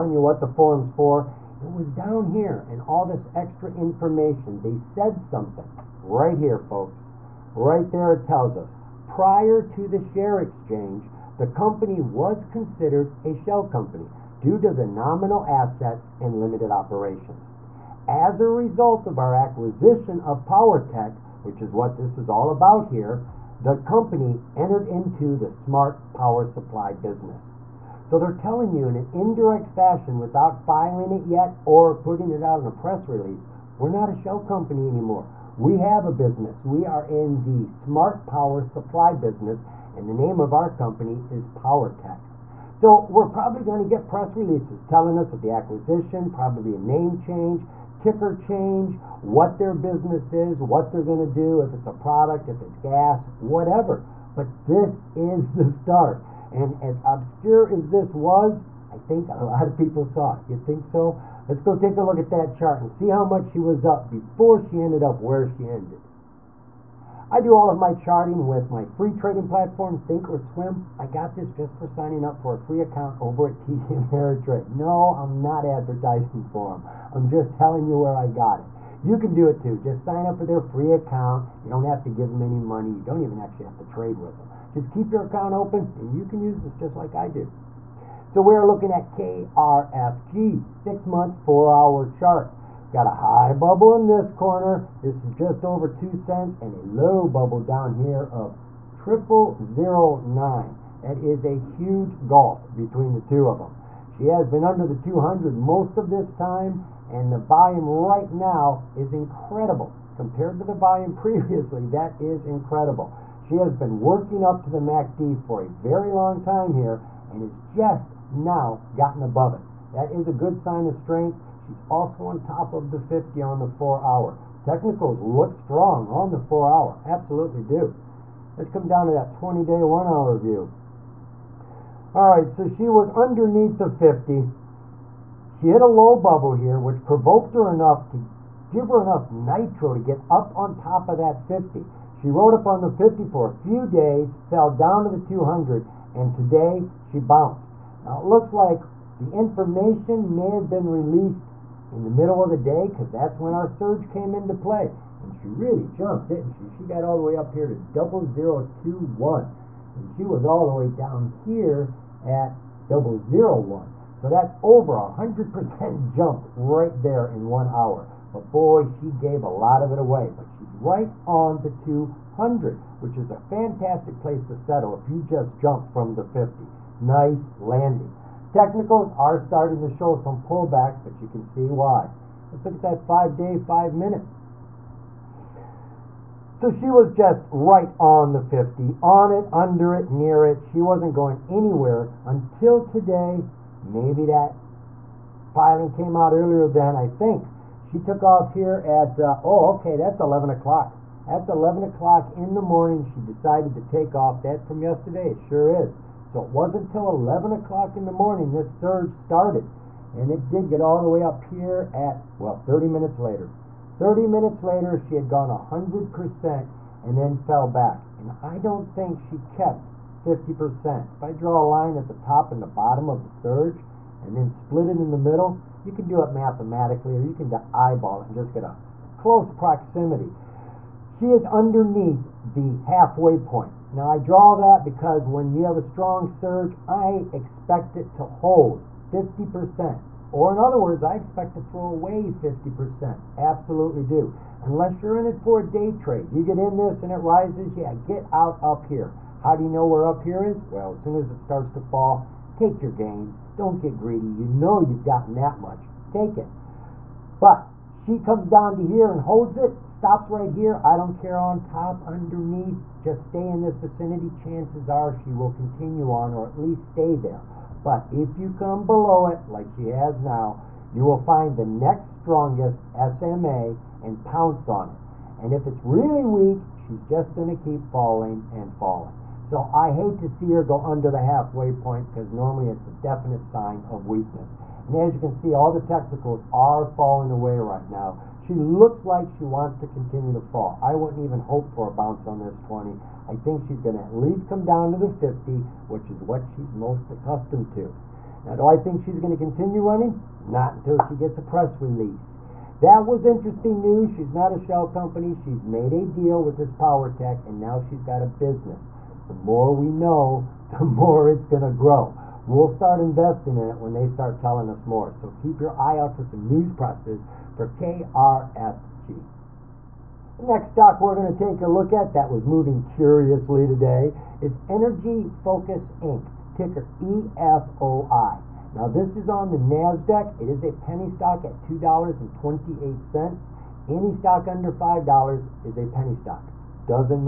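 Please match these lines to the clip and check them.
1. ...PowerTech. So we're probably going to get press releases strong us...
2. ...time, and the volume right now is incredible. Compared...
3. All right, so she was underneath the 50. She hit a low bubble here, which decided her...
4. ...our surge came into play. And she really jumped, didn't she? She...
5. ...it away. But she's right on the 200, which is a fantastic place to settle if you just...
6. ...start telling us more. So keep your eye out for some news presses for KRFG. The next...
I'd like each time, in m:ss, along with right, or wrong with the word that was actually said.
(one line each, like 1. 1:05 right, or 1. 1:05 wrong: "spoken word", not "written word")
1. 0:41 wrong: "telling", not "strong"
2. 1:46 right
3. 2:12 wrong: "provoked", not "decided"
4. 2:33 right
5. 2:49 right
6. 5:14 right.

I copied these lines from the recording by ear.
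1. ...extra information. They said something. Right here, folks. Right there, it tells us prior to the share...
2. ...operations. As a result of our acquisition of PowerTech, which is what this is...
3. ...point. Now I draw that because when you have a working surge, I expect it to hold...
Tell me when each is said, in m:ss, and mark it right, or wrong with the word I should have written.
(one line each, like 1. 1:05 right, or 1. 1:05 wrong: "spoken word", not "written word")
1. 0:03 right
2. 0:16 right
3. 3:53 wrong: "strong", not "working".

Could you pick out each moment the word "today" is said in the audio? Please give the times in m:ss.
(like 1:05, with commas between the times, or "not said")
2:26, 3:12, 5:23.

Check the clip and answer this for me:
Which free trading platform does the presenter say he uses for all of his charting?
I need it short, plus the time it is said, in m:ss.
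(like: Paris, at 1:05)
Think or Swim, at 1:09.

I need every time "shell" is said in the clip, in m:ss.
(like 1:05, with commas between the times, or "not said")
0:13, 0:34, 5:04.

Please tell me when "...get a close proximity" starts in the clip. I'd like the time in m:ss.
3:48.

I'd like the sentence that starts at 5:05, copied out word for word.
She's made a deal with this power tech, and now she's got a business.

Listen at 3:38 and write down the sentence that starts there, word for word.
And I don't think she kept 50%.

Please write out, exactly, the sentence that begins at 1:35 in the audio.
This is just over two cents and a low bubble down here of triple zero nine.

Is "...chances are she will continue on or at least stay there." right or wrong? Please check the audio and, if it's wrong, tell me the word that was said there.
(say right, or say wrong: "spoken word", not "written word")
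right.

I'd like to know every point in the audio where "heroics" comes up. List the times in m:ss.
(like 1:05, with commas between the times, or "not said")
not said.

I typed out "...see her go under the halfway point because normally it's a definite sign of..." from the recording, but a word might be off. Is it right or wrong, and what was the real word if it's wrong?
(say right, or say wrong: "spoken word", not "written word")
right.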